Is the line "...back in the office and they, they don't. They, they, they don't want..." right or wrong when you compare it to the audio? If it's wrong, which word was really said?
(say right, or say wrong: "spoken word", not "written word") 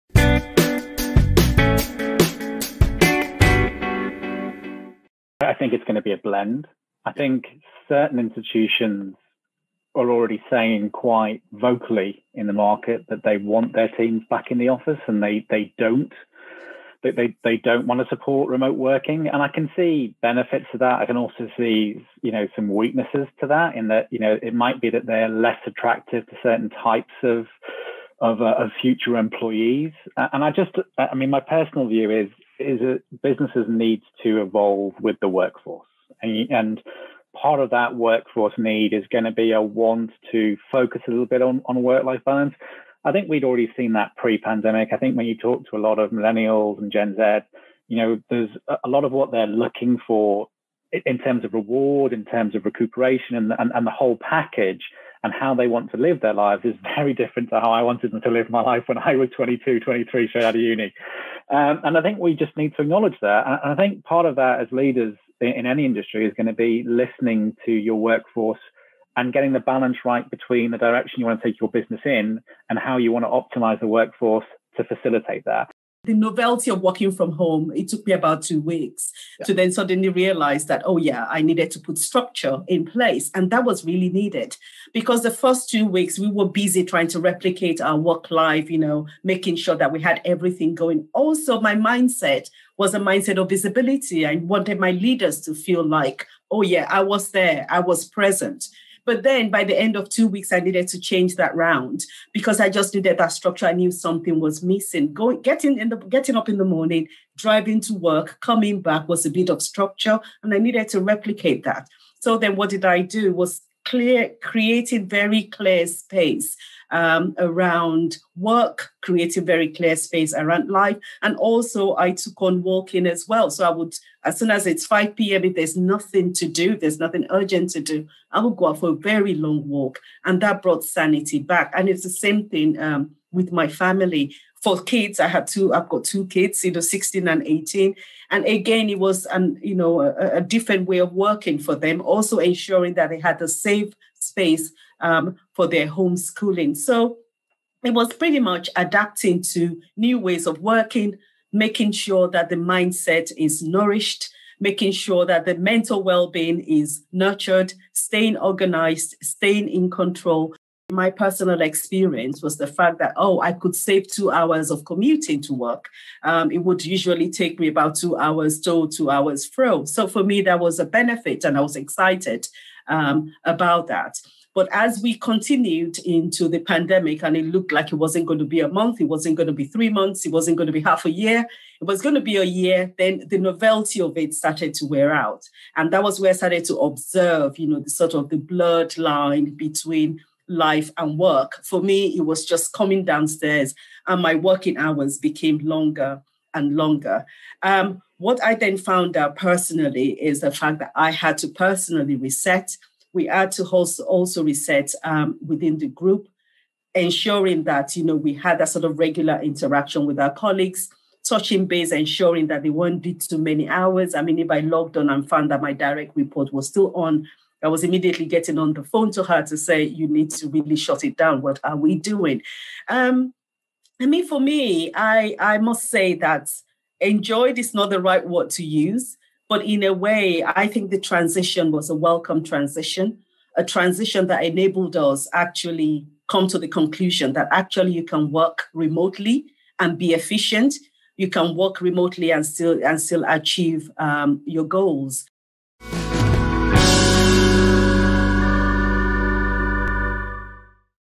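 right.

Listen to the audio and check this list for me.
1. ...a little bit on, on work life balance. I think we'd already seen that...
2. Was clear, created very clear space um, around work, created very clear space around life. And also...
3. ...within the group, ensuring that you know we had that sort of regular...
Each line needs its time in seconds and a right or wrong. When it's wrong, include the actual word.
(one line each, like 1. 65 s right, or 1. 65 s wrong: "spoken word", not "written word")
1. 41 s right
2. 113 s right
3. 205 s right.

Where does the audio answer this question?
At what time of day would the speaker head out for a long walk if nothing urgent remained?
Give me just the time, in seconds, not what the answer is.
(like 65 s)
124 s.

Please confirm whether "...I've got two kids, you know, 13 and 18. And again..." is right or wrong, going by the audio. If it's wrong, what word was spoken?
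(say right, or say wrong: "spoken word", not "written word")
wrong: "16", not "13".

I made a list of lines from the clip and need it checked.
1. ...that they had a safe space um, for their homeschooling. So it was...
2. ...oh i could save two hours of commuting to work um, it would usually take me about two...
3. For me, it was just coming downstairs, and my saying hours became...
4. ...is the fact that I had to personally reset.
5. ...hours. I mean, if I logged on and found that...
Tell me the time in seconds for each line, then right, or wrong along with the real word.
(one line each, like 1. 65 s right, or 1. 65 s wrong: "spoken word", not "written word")
1. 142 s right
2. 163 s right
3. 191 s wrong: "working", not "saying"
4. 200 s right
5. 213 s right.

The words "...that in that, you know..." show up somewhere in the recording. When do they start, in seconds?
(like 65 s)
23 s.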